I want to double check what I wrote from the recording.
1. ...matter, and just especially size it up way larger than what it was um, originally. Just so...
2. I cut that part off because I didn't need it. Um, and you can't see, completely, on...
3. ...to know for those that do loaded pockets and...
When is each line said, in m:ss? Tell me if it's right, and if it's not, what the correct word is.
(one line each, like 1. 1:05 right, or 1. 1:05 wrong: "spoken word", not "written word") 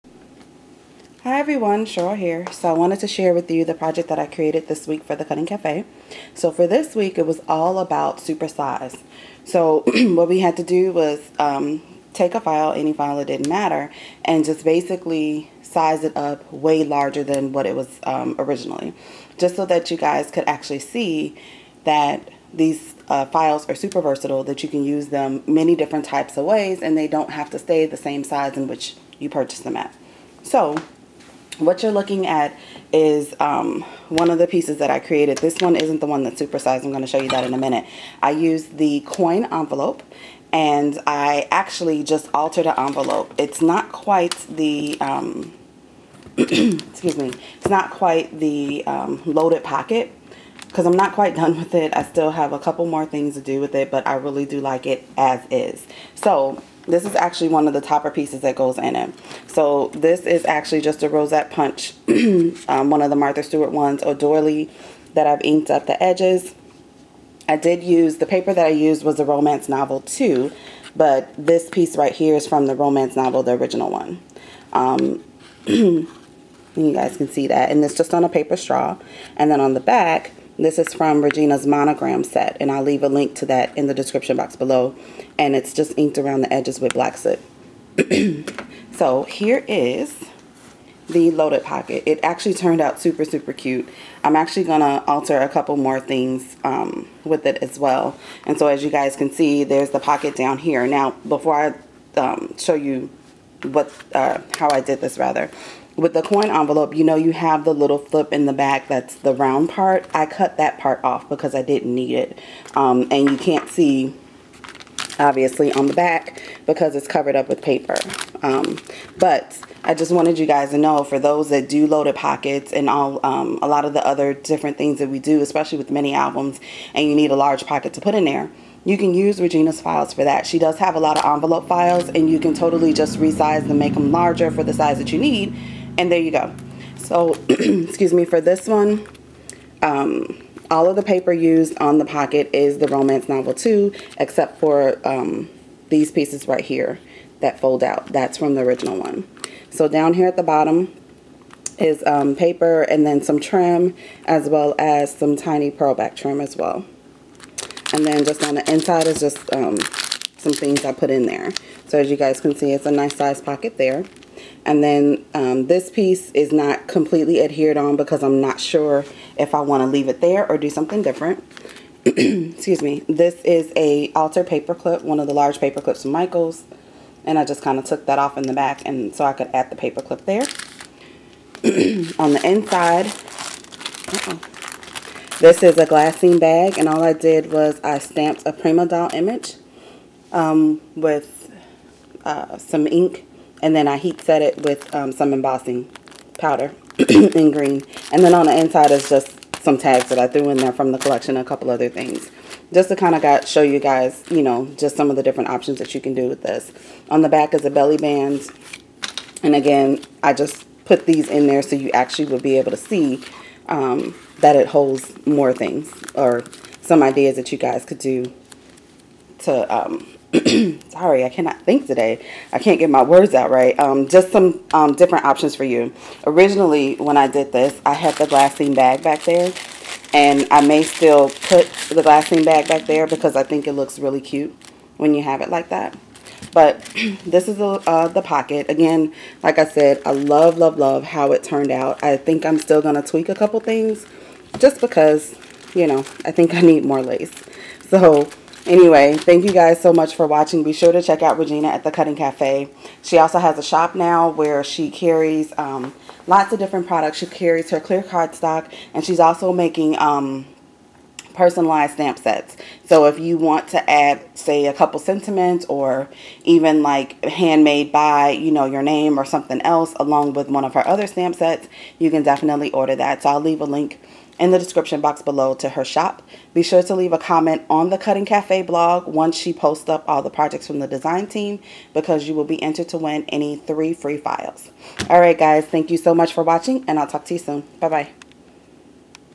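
1. 0:13 wrong: "basically", not "especially"
2. 1:50 wrong: "obviously", not "completely"
3. 2:00 right.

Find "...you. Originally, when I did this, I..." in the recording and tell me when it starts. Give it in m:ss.
3:45.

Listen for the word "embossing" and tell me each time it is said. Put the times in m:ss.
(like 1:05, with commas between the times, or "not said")
3:15.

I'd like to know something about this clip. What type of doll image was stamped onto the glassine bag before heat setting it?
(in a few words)
Prima Doll.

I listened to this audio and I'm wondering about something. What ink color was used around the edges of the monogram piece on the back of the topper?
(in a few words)
black soot.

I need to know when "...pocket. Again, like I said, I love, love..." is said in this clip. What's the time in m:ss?
3:58.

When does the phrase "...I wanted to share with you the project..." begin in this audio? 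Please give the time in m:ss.
0:02.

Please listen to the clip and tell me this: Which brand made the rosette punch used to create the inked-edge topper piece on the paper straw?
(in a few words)
Martha Stewart.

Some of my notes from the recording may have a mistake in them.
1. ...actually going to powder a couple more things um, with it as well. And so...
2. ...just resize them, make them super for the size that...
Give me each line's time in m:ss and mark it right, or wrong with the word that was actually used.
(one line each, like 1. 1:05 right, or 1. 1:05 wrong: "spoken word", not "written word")
1. 1:34 wrong: "alter", not "powder"
2. 2:12 wrong: "larger", not "super".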